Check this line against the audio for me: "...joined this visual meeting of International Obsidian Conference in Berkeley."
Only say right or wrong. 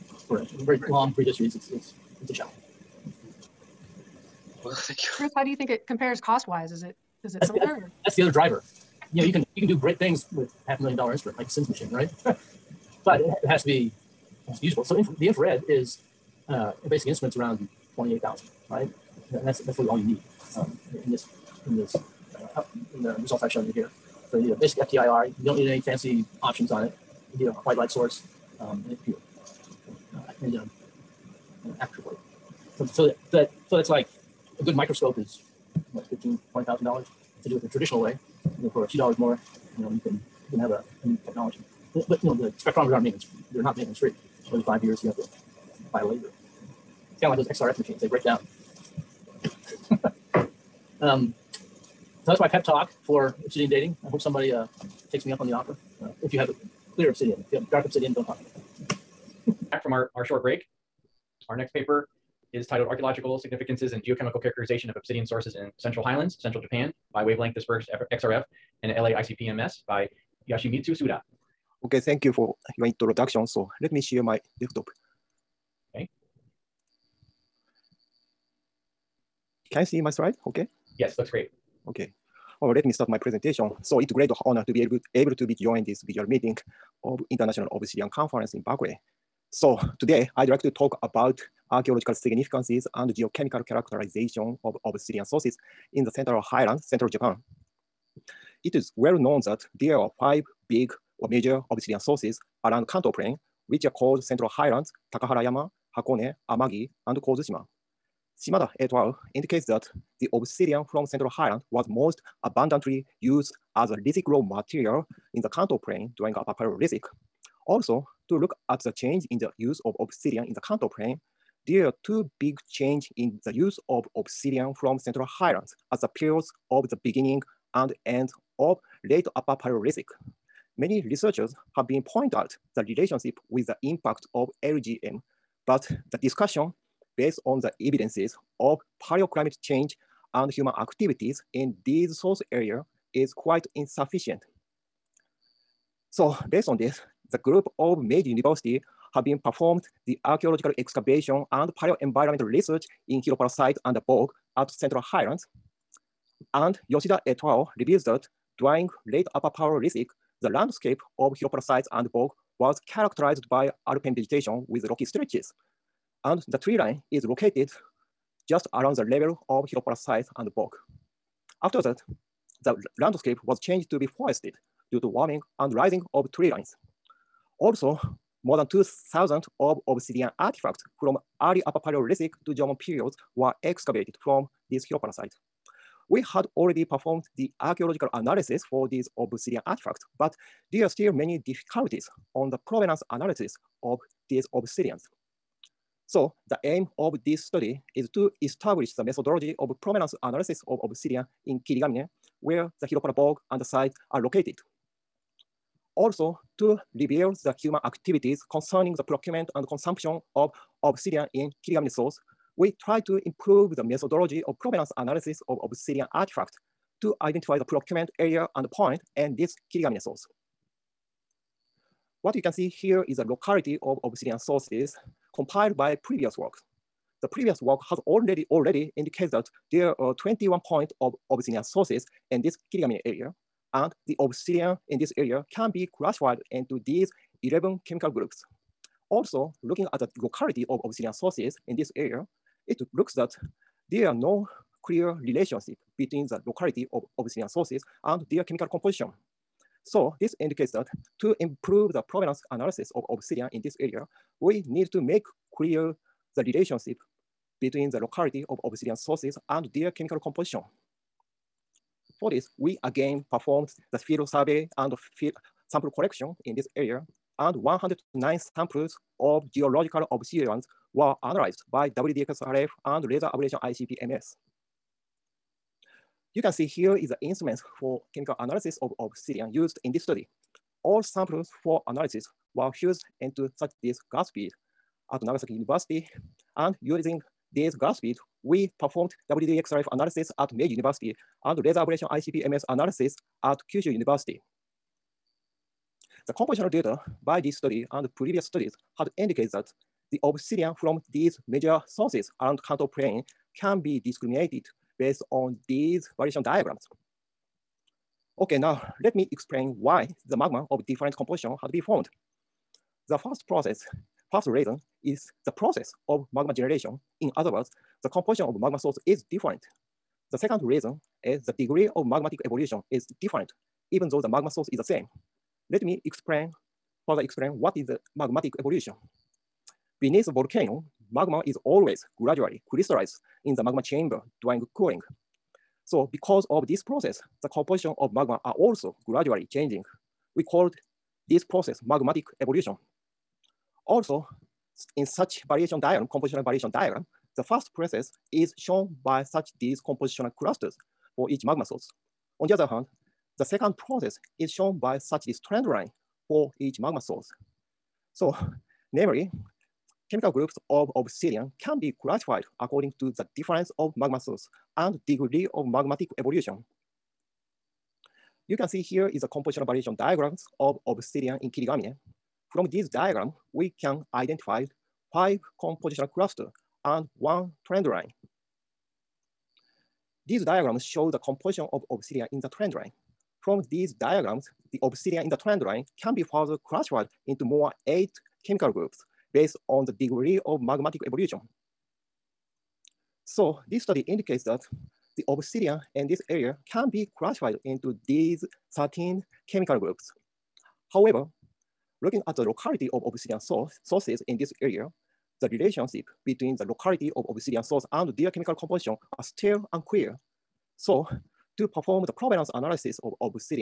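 right.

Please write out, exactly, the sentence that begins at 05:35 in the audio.
So because of this process, the composition of magma are also gradually changing.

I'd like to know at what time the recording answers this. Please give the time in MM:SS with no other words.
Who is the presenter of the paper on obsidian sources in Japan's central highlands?
01:10.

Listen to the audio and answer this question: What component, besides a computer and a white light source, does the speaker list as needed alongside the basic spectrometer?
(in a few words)
an aperture plate.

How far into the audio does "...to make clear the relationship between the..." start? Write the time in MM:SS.
04:14.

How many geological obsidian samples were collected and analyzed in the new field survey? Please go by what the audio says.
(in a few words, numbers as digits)
109.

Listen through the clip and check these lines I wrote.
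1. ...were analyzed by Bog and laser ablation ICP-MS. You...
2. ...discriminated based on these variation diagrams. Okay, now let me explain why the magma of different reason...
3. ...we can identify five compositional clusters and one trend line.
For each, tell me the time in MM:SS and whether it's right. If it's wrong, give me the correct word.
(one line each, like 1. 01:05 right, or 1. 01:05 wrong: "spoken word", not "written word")
1. 04:30 wrong: "WDXRF", not "Bog"
2. 05:03 wrong: "composition", not "reason"
3. 06:13 right.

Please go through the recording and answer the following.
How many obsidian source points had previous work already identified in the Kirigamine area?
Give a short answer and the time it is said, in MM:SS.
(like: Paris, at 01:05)
21, at 03:50.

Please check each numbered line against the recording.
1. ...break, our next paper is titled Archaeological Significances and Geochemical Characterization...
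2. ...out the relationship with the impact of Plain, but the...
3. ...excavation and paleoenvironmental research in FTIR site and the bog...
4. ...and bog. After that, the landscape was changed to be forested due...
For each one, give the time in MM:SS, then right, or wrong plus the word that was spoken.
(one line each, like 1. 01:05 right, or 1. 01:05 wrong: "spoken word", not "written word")
1. 01:00 right
2. 02:12 wrong: "LGM", not "Plain"
3. 02:30 wrong: "Hiropara", not "FTIR"
4. 02:50 right.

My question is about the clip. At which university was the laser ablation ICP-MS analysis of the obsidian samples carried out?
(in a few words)
Kyushu University.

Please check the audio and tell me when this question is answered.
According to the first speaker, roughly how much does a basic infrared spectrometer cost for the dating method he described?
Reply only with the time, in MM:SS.
00:17.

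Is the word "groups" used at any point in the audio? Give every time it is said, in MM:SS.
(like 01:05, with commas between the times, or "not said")
02:27, 03:58, 06:00, 06:28, 06:39.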